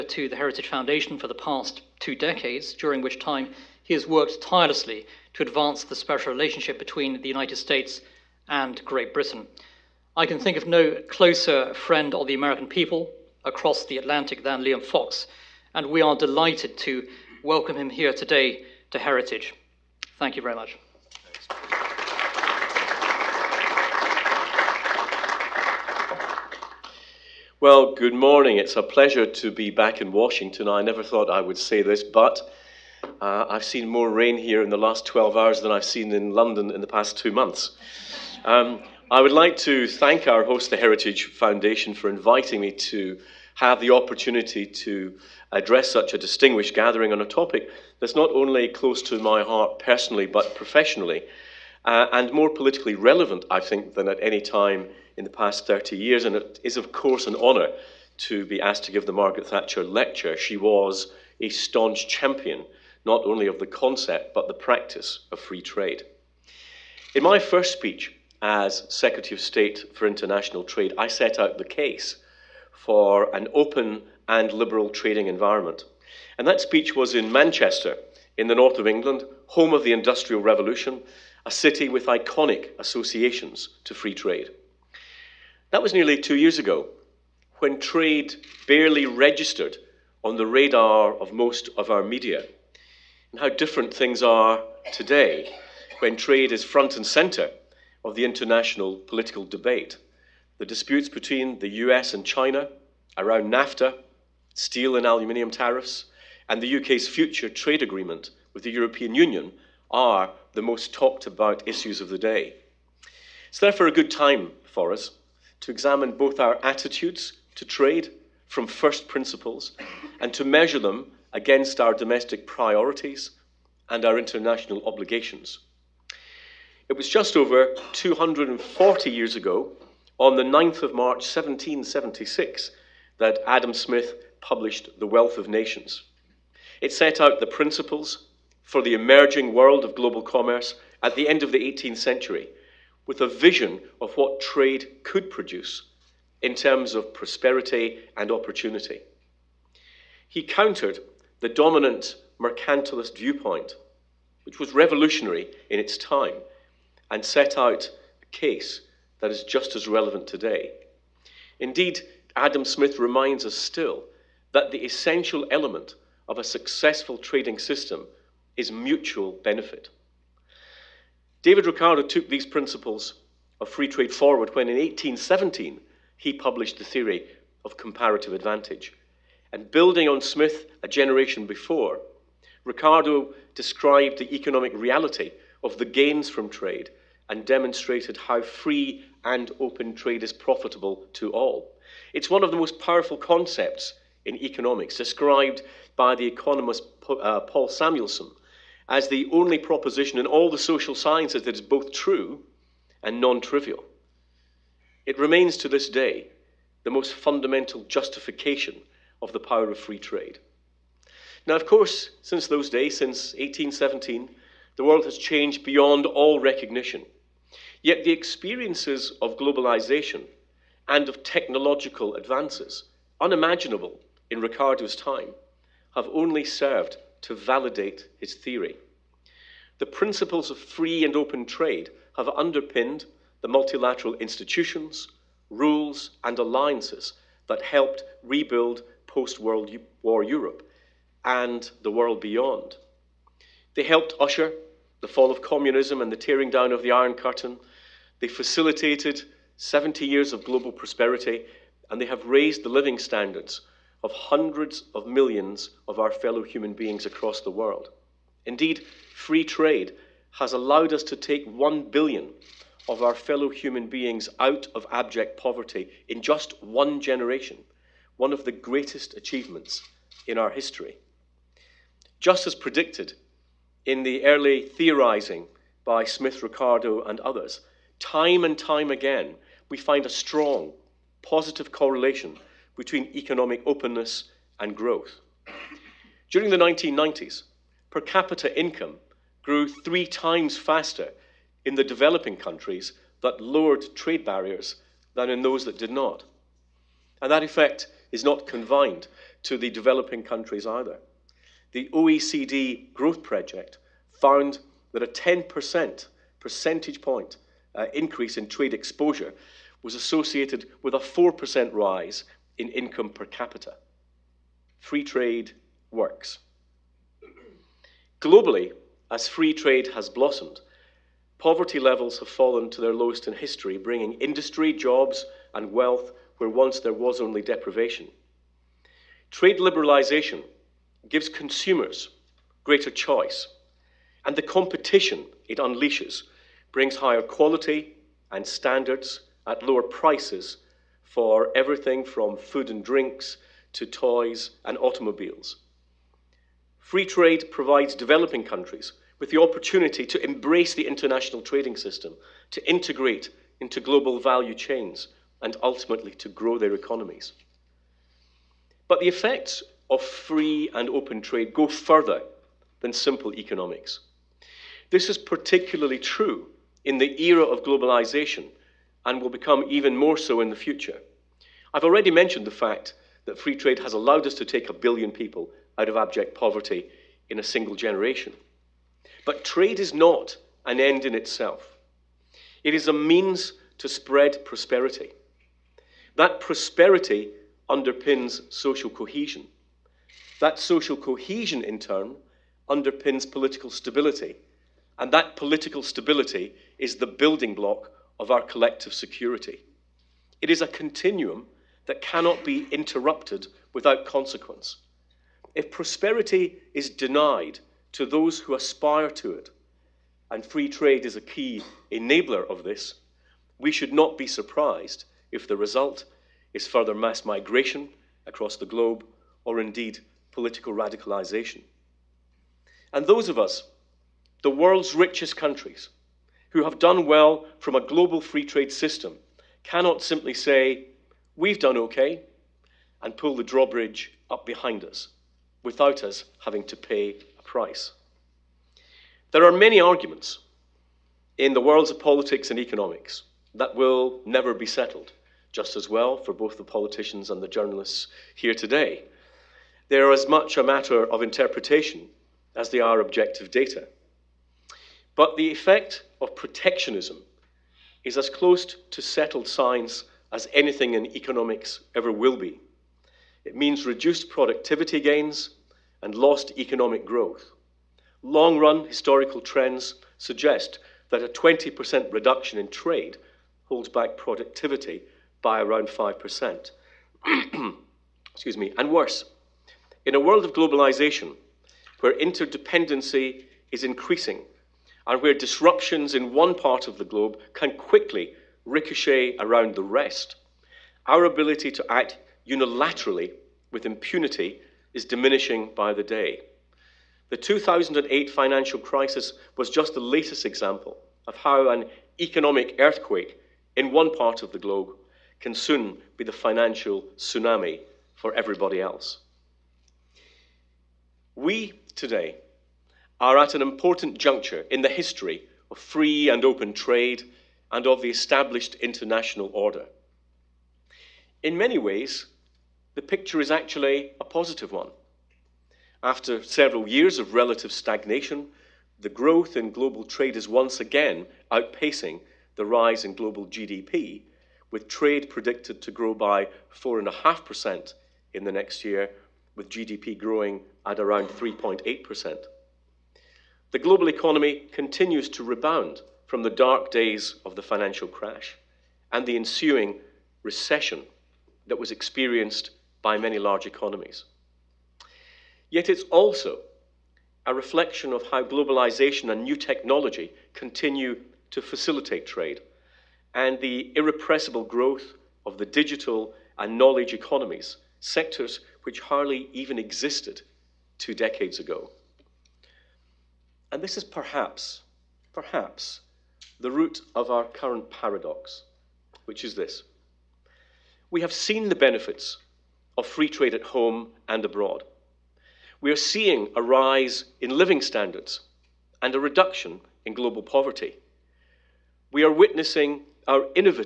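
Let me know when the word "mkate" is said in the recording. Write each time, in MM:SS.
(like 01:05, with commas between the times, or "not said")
not said.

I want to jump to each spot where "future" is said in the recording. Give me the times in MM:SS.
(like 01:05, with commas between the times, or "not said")
01:47, 06:10.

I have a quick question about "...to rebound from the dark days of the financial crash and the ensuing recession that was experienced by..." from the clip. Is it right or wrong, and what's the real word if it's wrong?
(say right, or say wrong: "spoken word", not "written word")
right.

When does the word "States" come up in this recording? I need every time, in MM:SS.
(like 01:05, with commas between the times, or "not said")
00:07, 01:09.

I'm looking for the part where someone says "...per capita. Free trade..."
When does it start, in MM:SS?
05:13.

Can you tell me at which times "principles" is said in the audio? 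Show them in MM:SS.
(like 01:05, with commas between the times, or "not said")
01:59, 02:17, 02:52, 03:49.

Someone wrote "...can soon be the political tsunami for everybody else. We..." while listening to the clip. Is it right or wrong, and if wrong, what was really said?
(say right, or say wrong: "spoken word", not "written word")
wrong: "financial", not "political".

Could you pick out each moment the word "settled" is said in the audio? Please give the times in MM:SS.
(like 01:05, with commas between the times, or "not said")
07:24, 07:39.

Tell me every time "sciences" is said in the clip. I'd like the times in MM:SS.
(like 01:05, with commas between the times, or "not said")
03:20, 07:39.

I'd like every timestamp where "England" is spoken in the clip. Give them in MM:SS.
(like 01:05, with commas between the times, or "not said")
01:18.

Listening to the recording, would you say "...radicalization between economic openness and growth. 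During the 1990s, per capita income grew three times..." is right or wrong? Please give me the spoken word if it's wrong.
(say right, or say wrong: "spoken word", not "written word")
wrong: "correlation", not "radicalization".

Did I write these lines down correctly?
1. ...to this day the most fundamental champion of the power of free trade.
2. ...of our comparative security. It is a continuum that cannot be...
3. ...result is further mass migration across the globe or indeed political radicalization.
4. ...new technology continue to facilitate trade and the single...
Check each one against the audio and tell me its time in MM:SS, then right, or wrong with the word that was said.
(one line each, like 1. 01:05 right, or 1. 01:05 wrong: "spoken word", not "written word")
1. 03:25 wrong: "justification", not "champion"
2. 06:38 wrong: "collective", not "comparative"
3. 06:55 right
4. 09:19 wrong: "irrepressible", not "single".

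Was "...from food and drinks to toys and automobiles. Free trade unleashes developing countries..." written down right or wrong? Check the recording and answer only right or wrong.
wrong.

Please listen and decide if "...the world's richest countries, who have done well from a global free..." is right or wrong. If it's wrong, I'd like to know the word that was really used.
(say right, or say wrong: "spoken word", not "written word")
right.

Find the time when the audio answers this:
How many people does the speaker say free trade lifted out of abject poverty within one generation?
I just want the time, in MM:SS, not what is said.
04:21.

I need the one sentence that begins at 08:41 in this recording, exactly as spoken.
In many ways, the picture is actually a positive one.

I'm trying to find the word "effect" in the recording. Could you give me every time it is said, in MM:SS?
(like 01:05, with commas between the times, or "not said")
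04:57, 05:59, 07:35.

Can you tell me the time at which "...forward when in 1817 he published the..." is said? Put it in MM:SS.
02:54.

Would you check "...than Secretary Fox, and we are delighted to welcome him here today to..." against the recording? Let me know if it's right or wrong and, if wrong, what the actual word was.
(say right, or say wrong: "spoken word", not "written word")
wrong: "Liam", not "Secretary".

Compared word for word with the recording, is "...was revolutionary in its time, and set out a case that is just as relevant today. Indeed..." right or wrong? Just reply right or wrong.
right.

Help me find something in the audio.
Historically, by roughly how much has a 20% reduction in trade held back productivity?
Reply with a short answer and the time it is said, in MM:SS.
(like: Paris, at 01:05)
5%, at 07:55.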